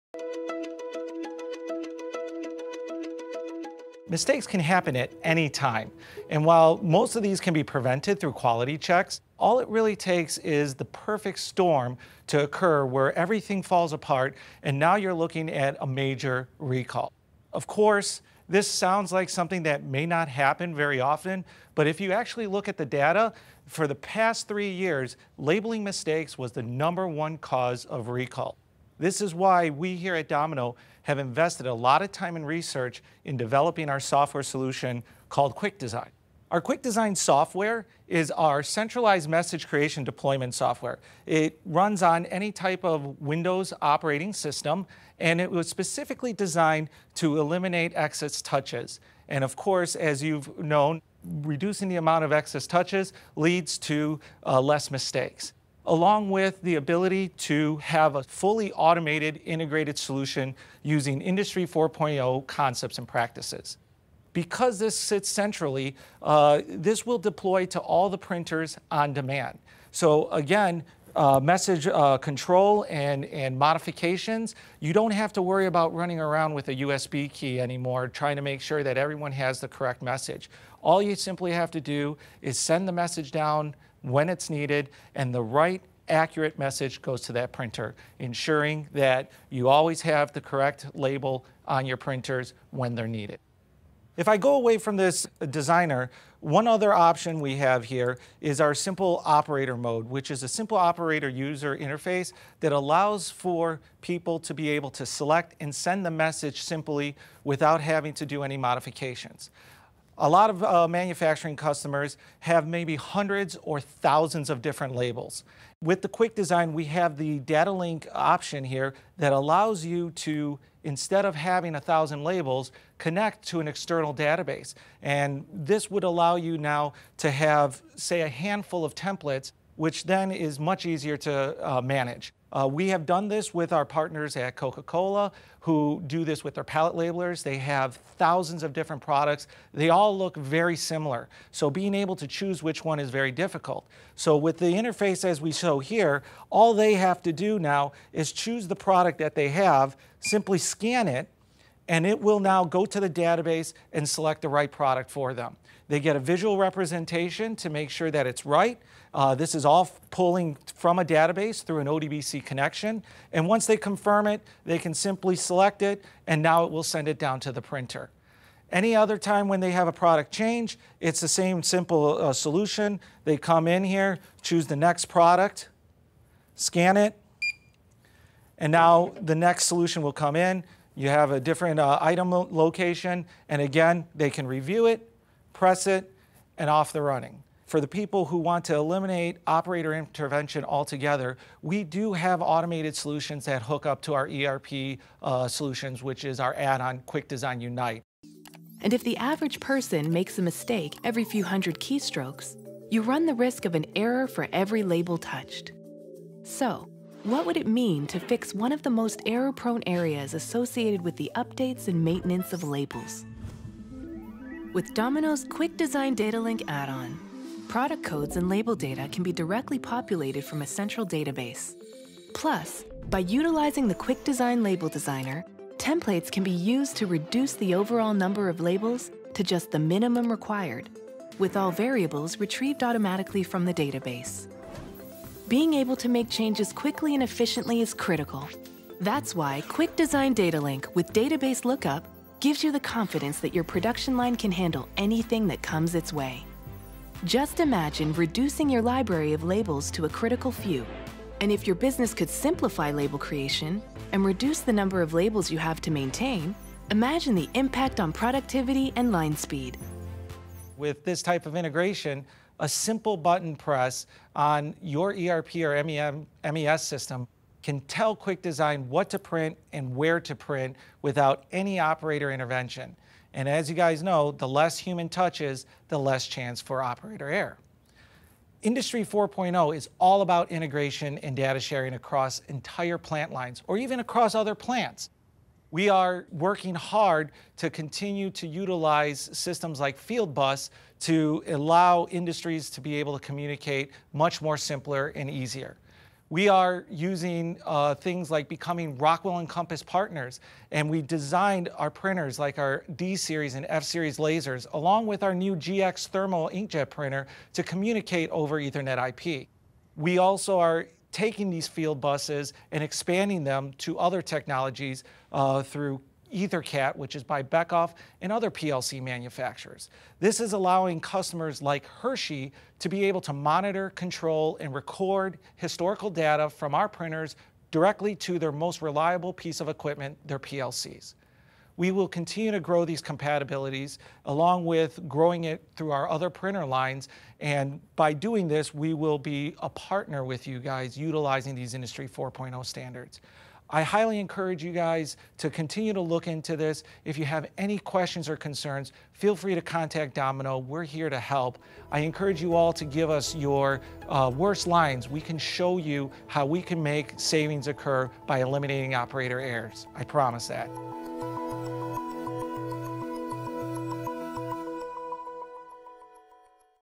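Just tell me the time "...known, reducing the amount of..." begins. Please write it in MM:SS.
00:50.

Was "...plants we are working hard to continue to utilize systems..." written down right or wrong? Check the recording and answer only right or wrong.
right.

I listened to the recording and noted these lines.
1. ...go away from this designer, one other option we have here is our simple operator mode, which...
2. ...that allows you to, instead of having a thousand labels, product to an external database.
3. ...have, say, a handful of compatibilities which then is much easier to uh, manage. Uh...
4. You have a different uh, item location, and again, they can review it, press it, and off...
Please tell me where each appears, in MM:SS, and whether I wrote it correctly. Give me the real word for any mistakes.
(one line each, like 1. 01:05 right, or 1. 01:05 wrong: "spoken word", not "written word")
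1. 01:34 right
2. 01:59 wrong: "connect", not "product"
3. 02:07 wrong: "templates", not "compatibilities"
4. 03:00 right.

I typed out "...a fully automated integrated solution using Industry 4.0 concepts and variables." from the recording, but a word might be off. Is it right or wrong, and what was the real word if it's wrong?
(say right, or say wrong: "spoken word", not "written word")
wrong: "practices", not "variables".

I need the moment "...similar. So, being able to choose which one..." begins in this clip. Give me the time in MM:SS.
02:20.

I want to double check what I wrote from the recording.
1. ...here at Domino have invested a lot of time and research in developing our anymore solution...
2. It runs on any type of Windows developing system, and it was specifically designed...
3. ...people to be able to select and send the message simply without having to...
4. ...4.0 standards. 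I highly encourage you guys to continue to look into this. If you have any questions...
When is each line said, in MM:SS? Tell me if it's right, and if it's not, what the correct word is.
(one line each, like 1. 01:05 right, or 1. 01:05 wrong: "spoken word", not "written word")
1. 00:29 wrong: "software", not "anymore"
2. 00:41 wrong: "operating", not "developing"
3. 01:44 right
4. 05:42 right.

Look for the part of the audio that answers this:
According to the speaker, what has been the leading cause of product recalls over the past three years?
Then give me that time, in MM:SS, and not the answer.
00:25.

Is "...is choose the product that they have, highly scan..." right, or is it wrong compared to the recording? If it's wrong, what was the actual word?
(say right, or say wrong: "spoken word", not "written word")
wrong: "simply", not "highly".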